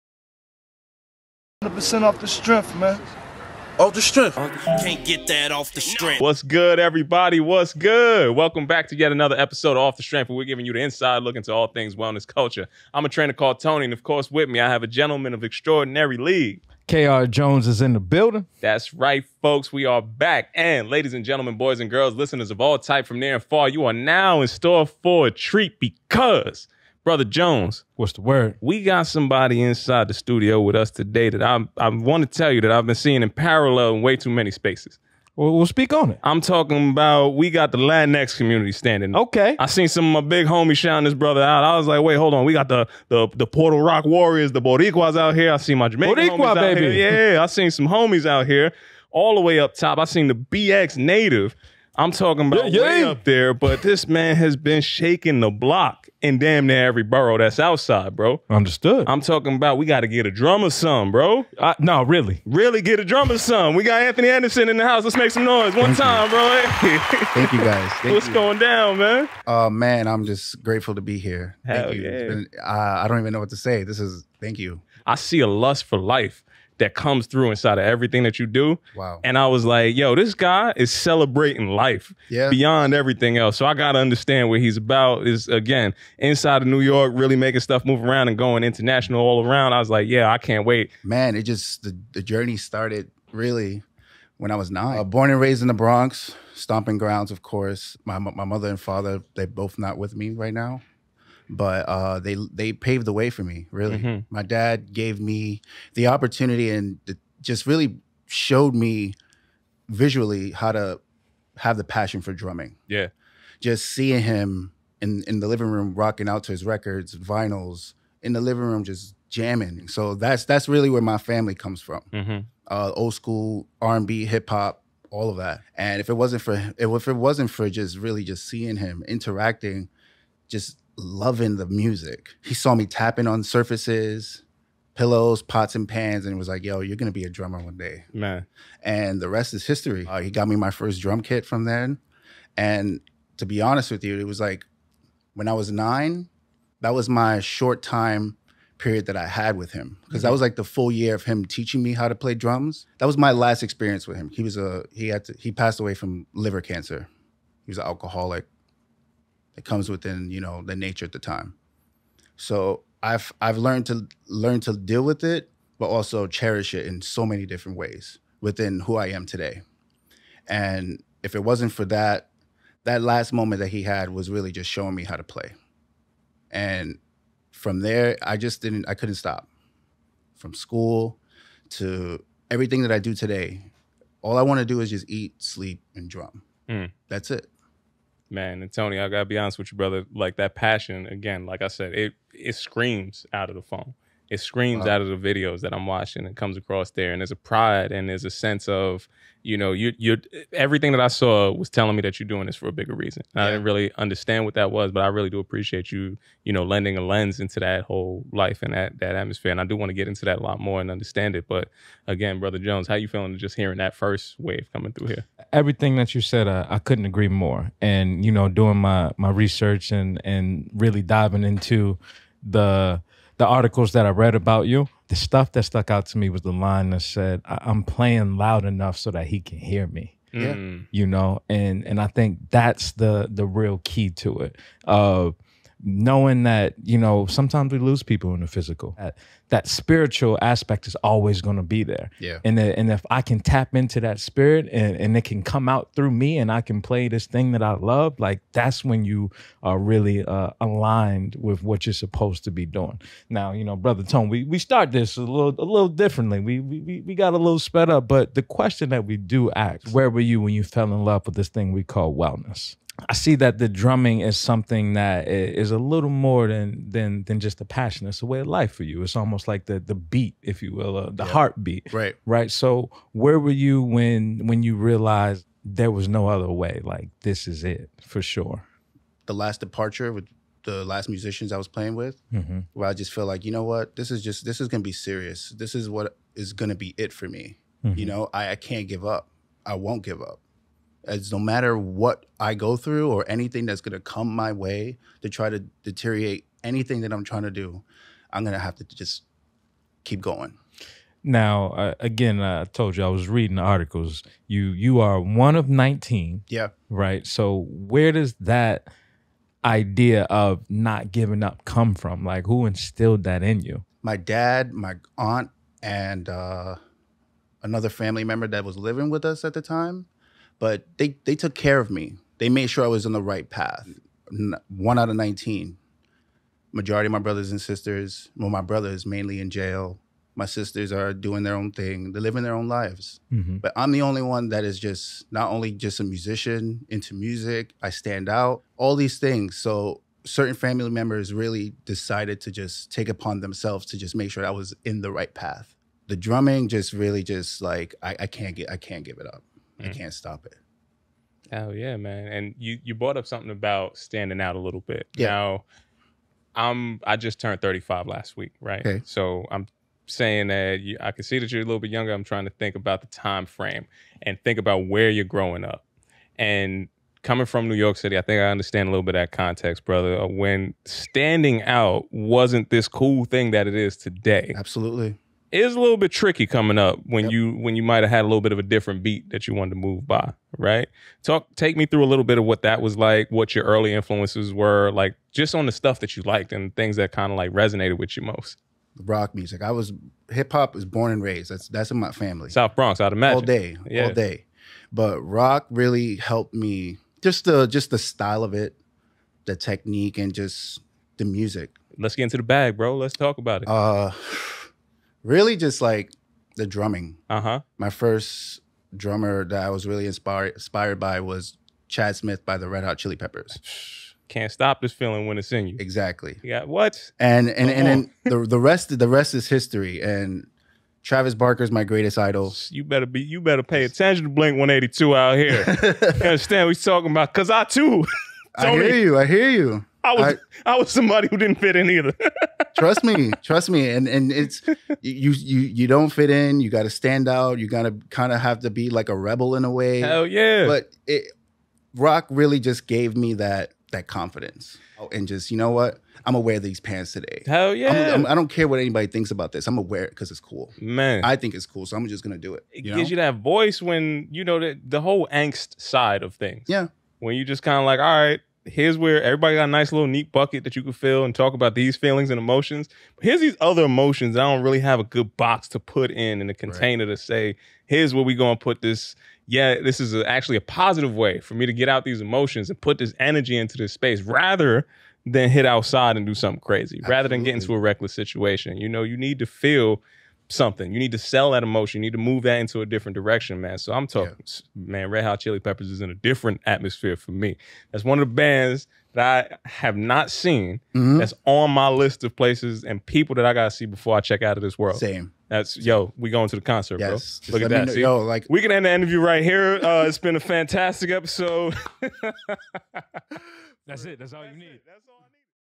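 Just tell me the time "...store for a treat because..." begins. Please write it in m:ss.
0:24.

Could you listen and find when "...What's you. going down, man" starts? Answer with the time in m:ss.
1:08.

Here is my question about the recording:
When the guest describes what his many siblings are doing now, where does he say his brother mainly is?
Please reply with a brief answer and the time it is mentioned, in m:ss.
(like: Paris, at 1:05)
jail, at 5:29.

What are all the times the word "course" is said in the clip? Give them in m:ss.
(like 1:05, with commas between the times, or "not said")
0:14, 1:37.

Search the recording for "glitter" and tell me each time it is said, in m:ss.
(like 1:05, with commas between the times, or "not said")
not said.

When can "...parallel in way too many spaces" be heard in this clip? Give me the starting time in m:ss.
0:33.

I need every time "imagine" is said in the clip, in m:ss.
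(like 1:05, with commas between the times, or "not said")
6:33.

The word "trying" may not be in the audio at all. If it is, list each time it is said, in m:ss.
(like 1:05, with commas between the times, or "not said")
4:57, 6:02.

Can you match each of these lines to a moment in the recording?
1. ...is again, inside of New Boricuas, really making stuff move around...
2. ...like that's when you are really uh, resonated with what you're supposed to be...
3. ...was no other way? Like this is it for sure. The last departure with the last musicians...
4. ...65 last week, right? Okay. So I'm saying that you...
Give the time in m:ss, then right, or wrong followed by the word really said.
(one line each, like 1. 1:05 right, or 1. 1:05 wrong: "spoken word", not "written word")
1. 1:25 wrong: "York", not "Boricuas"
2. 4:08 wrong: "aligned", not "resonated"
3. 4:35 right
4. 5:57 wrong: "35", not "65".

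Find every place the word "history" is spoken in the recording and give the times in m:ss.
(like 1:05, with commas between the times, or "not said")
2:19, 6:59.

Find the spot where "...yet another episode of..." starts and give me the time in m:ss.
0:08.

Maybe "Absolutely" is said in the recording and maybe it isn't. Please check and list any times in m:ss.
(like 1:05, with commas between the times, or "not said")
6:14, 7:56.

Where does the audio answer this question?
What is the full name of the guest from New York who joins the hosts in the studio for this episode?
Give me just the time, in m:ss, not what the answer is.
1:04.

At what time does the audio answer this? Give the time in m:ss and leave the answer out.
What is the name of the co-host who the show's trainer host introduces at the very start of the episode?
0:16.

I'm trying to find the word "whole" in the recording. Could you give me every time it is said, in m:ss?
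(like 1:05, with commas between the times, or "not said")
3:27, 7:35.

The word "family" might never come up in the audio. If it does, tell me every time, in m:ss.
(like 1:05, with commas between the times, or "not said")
2:01, 5:17, 5:40, 6:32.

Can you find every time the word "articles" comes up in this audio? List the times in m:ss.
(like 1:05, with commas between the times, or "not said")
3:43, 5:03.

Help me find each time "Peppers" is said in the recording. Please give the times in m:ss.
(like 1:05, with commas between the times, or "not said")
6:53, 8:05.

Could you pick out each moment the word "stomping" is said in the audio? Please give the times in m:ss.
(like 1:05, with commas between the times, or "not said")
1:36.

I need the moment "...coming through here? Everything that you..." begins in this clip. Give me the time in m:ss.
3:34.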